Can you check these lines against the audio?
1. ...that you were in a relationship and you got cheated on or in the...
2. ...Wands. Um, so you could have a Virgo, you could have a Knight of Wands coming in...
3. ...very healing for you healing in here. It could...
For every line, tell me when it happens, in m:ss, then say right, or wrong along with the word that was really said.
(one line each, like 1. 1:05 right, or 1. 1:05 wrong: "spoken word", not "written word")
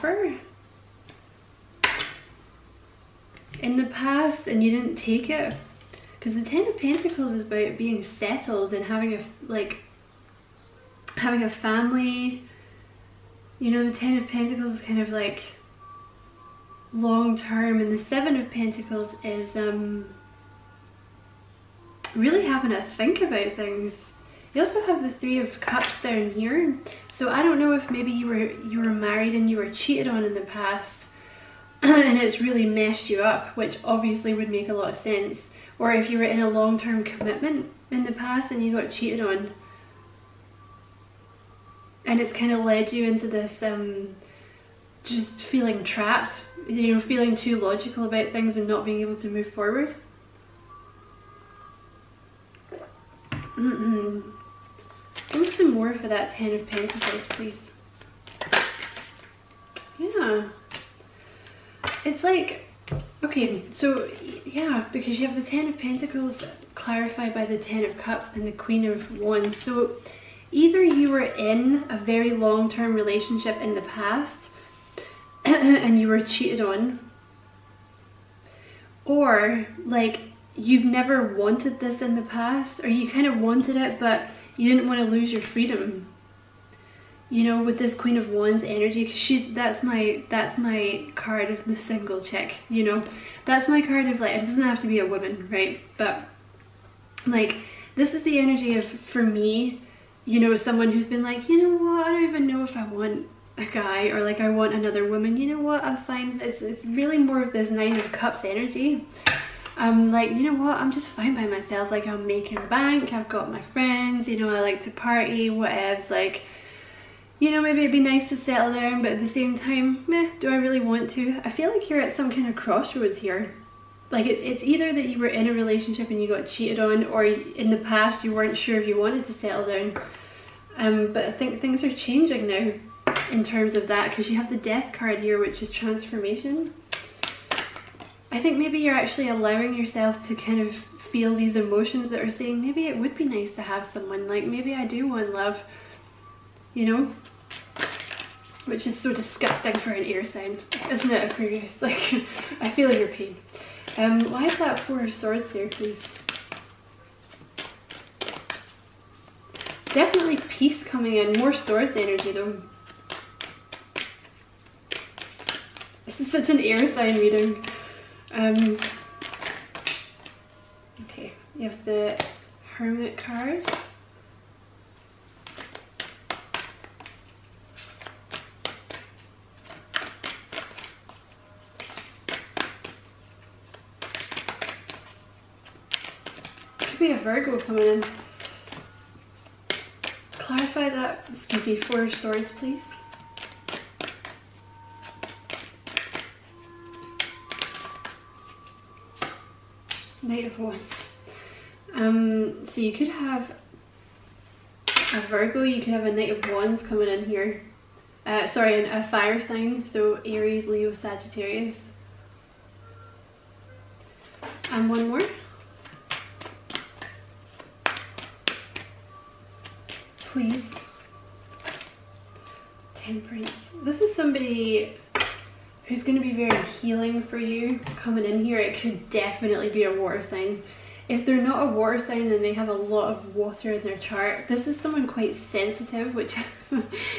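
1. 2:04 right
2. 3:20 right
3. 3:46 wrong: "coming", not "healing".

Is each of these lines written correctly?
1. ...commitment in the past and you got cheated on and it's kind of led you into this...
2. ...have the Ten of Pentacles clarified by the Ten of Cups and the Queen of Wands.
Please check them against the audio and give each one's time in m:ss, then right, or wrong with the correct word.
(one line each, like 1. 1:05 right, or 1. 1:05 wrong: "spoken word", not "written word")
1. 0:37 right
2. 1:05 right.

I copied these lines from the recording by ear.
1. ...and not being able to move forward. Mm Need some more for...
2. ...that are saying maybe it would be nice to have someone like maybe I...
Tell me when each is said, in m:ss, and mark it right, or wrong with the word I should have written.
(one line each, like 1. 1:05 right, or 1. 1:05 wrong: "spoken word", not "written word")
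1. 0:48 right
2. 2:22 right.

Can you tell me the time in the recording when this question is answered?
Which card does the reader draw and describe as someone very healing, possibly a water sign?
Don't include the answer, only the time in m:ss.
3:42.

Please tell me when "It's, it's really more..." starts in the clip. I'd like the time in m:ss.
1:46.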